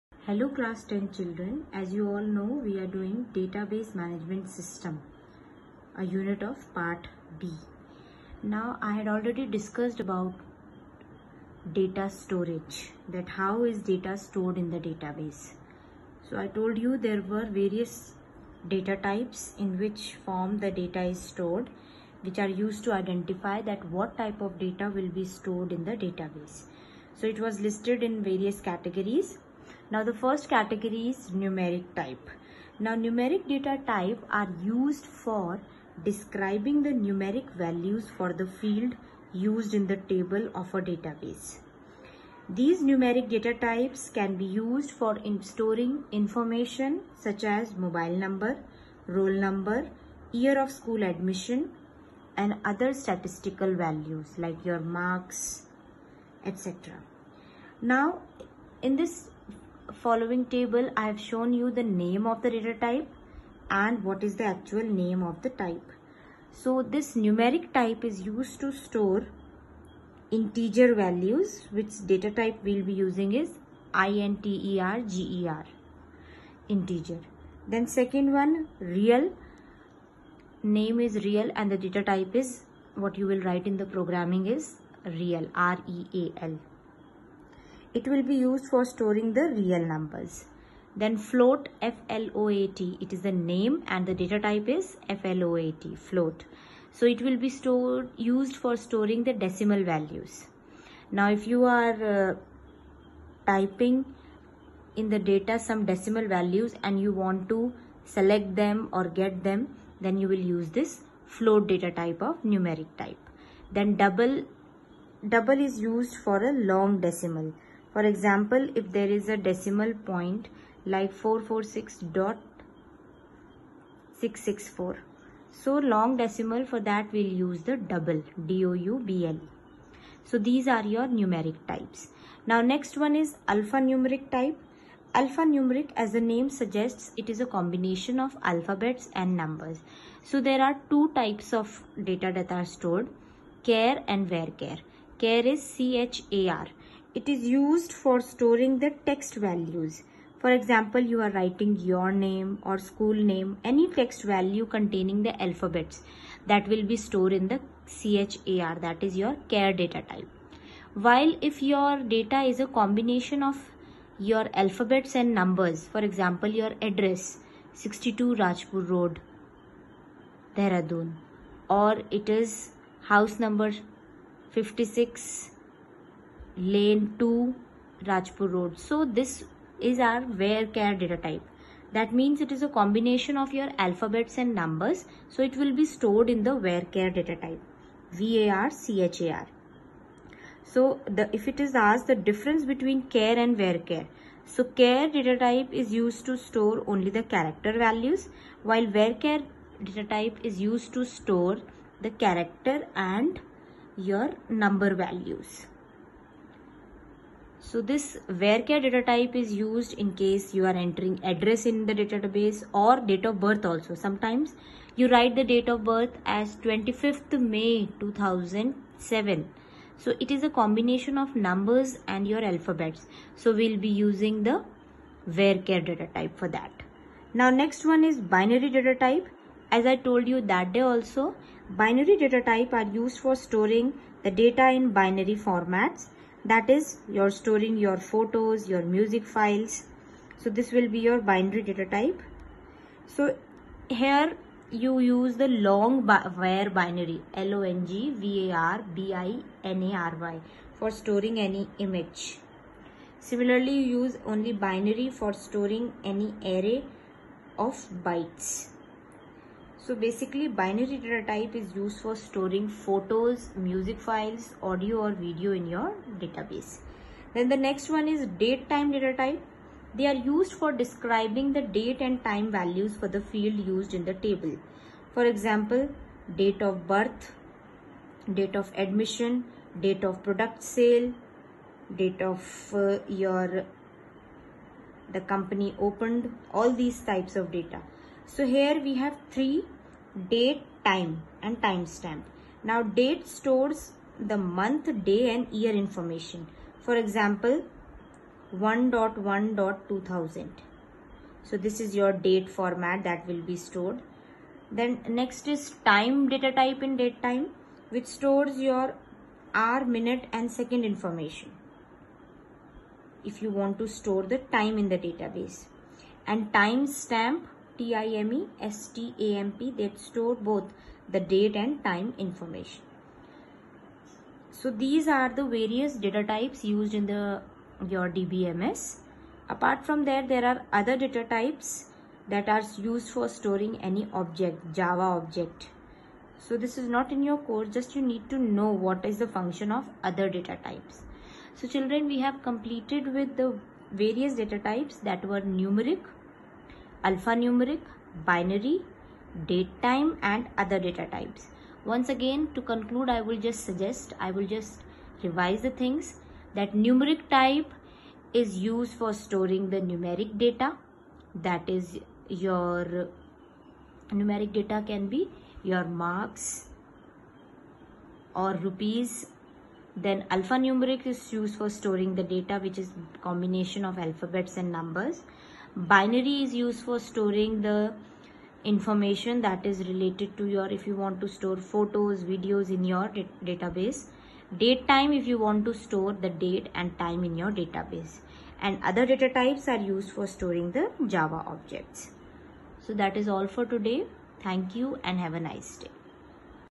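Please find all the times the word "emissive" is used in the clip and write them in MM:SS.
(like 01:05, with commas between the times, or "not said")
not said.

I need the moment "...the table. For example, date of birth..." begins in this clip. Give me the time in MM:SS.
04:34.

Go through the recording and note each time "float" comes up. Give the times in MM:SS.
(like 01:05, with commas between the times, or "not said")
01:31, 01:35, 01:51.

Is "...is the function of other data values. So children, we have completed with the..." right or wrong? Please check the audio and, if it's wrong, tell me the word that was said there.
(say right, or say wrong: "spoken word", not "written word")
wrong: "types", not "values".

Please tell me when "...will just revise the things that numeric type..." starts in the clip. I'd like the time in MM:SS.
05:54.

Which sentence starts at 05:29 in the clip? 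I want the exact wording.
Apart from that, there are other data types that are used for storing any object, Java object.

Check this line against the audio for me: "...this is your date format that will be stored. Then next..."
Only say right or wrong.
right.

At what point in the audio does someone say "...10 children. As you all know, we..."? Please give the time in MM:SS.
00:00.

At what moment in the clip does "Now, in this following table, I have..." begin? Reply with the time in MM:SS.
00:57.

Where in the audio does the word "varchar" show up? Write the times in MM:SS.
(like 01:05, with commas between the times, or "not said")
03:00, 03:06, 03:13, 03:18.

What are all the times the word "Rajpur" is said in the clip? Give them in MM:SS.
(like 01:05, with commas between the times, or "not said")
02:48, 02:58.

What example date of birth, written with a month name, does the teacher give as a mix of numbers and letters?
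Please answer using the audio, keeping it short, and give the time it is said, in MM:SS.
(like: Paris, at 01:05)
25th May 2007, at 03:36.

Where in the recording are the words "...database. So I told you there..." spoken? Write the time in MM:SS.
00:14.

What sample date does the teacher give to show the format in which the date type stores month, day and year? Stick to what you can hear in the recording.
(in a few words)
1.1.2000.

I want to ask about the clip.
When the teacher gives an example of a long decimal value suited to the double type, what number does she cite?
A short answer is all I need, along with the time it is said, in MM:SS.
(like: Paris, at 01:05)
446.664, at 02:01.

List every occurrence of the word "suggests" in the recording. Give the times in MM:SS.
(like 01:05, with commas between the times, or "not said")
02:16, 05:53.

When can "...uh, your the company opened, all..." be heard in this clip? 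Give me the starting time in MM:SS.
04:42.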